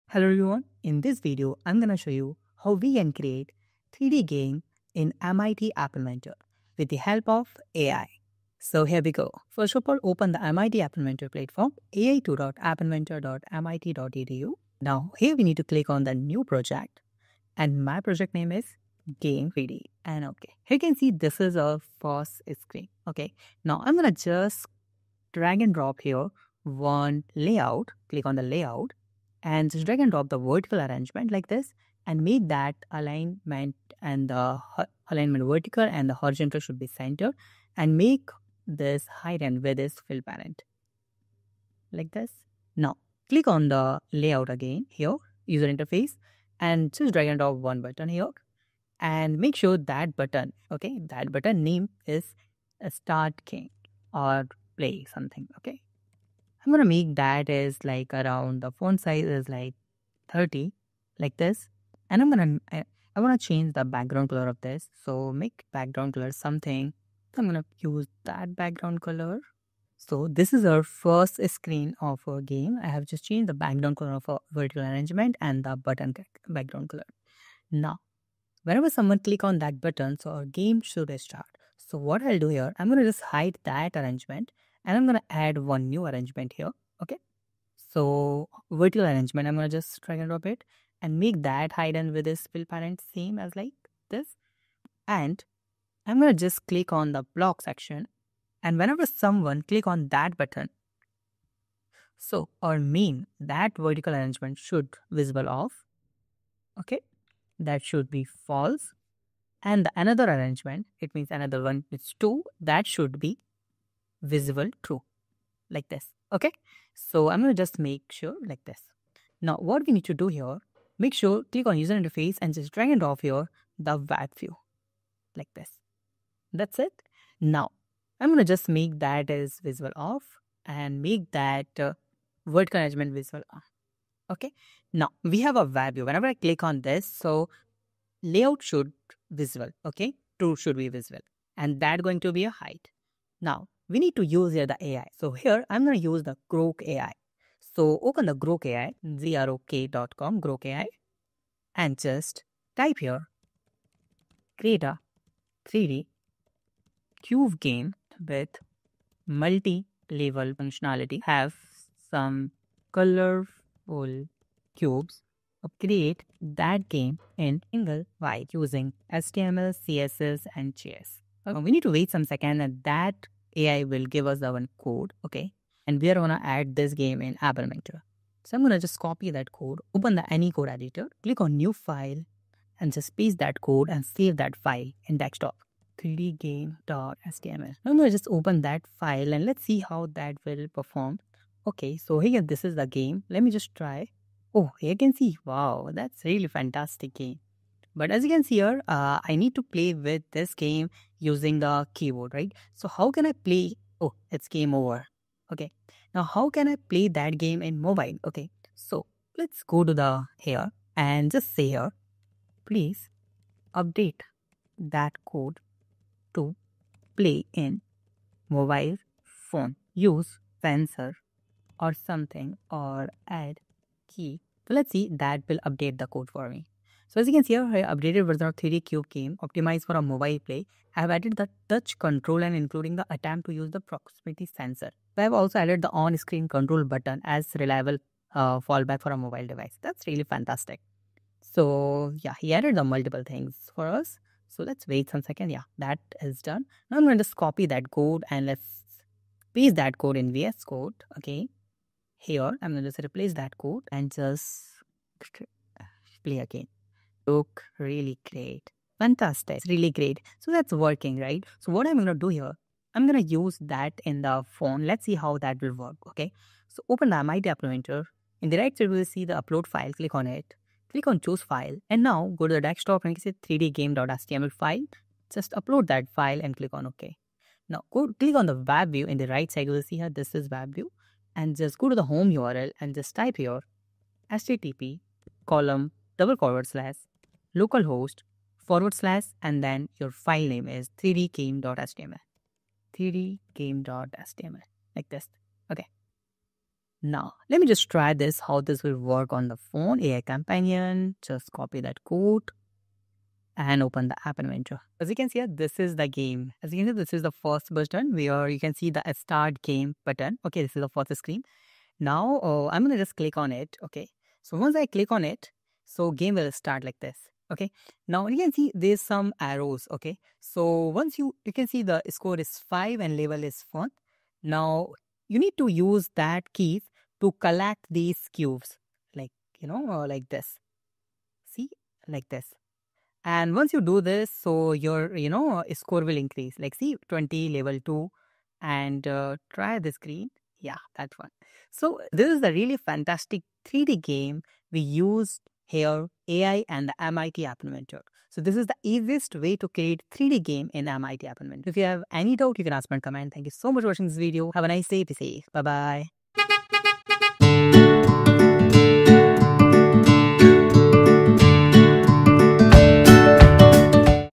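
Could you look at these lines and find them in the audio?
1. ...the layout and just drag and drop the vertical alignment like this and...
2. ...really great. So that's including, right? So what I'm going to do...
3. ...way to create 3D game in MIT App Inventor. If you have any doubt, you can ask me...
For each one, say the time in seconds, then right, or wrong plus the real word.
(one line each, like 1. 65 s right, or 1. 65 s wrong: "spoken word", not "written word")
1. 28 s wrong: "arrangement", not "alignment"
2. 259 s wrong: "working", not "including"
3. 349 s right.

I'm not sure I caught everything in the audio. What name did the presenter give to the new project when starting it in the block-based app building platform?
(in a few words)
Game 3D.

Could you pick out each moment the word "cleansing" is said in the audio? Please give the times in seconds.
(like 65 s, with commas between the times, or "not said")
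not said.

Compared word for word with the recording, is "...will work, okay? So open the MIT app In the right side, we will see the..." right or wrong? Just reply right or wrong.
right.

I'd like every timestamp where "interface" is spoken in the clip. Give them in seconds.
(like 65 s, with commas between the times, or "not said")
45 s, 121 s.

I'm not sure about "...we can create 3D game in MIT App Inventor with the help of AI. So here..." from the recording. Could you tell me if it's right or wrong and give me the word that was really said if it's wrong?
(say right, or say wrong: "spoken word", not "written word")
right.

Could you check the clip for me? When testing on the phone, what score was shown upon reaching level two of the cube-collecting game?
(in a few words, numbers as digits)
20.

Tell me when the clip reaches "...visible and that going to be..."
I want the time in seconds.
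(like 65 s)
140 s.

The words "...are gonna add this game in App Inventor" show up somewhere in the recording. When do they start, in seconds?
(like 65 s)
176 s.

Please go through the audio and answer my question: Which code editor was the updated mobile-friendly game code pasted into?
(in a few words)
VS Code.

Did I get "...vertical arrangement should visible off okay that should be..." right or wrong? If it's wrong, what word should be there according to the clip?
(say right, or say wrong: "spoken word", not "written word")
right.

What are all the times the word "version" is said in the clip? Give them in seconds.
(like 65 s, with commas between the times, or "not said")
228 s.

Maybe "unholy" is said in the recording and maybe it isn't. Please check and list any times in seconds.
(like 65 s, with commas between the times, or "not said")
not said.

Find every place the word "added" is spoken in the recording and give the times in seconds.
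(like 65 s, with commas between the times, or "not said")
231 s, 235 s, 242 s.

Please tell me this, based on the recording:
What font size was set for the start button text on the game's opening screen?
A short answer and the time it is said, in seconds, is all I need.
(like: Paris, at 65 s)
30, at 60 s.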